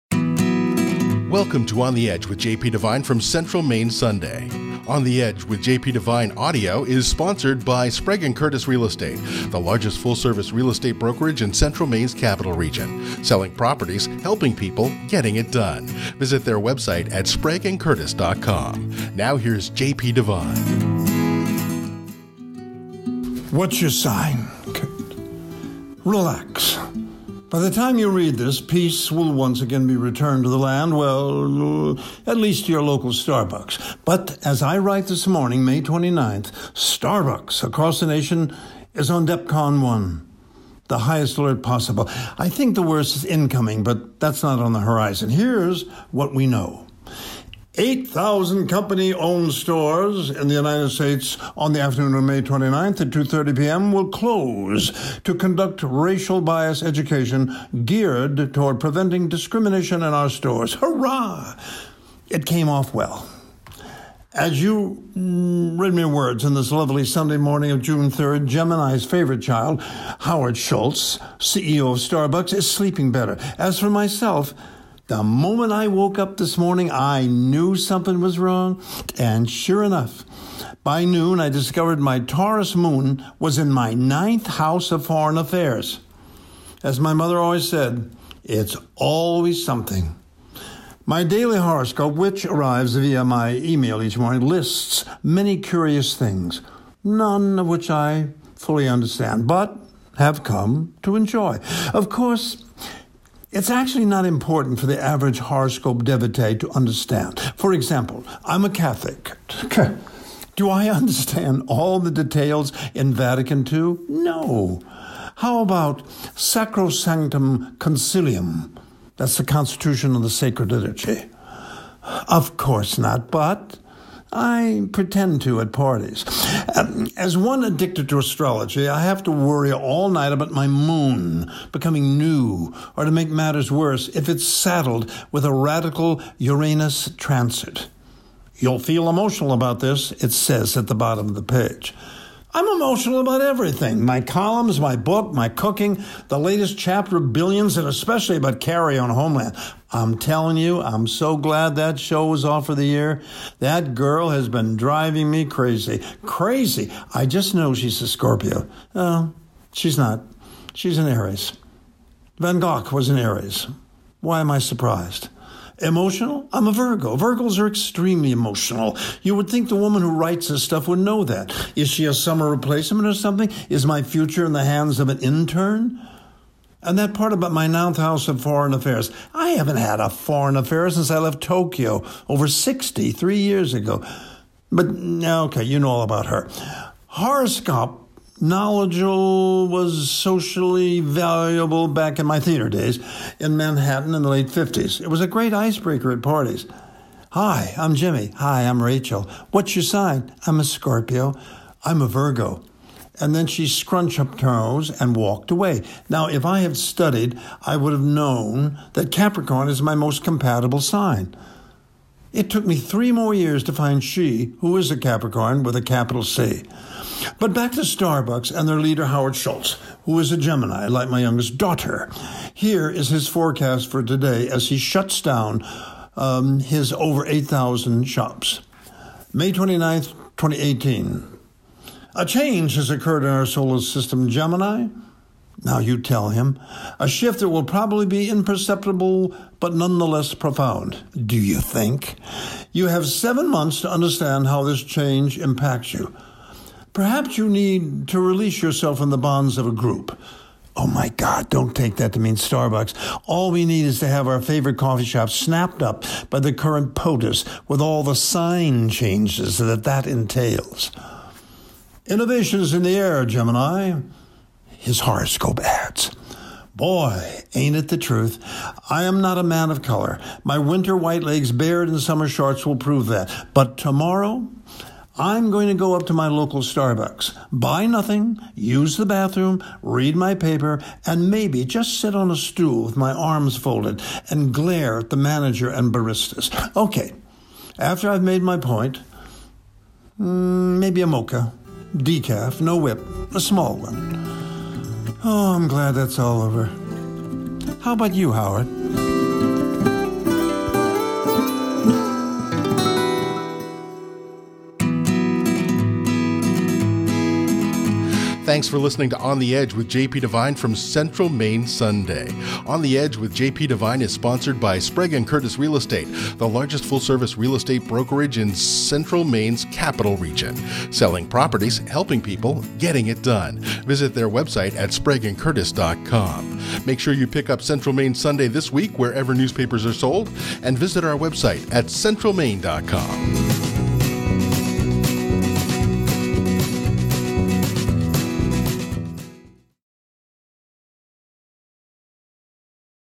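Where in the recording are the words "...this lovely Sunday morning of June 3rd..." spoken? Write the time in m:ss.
1:06.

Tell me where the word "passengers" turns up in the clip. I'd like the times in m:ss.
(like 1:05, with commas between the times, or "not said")
not said.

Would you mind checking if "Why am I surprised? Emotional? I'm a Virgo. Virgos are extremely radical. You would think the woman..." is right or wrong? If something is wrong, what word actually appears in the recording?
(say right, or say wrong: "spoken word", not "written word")
wrong: "emotional", not "radical".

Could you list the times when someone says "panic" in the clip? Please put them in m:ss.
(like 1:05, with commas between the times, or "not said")
not said.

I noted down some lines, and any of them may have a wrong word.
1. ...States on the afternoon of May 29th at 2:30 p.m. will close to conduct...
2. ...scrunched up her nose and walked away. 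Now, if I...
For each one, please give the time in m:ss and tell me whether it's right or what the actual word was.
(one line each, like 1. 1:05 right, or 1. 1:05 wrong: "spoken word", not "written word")
1. 0:50 right
2. 3:23 right.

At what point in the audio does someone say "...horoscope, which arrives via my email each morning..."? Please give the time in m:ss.
1:31.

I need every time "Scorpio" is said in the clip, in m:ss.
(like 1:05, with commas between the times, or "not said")
2:38, 3:20.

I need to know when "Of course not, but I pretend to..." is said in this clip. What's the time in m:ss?
2:02.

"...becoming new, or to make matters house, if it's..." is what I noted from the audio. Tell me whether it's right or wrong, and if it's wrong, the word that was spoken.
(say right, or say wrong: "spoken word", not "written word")
wrong: "worse", not "house".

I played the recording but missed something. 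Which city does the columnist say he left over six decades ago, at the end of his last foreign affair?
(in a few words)
Tokyo.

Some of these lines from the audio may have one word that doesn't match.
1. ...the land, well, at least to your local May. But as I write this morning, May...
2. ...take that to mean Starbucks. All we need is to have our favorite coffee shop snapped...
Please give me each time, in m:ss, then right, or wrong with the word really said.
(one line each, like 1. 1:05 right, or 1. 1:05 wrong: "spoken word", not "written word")
1. 0:30 wrong: "Starbucks", not "May"
2. 4:11 right.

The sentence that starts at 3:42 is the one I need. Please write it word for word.
Here is his forecast for today as he shuts down um, his over 8,000 shops.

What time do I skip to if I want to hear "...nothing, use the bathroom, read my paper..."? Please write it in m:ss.
4:37.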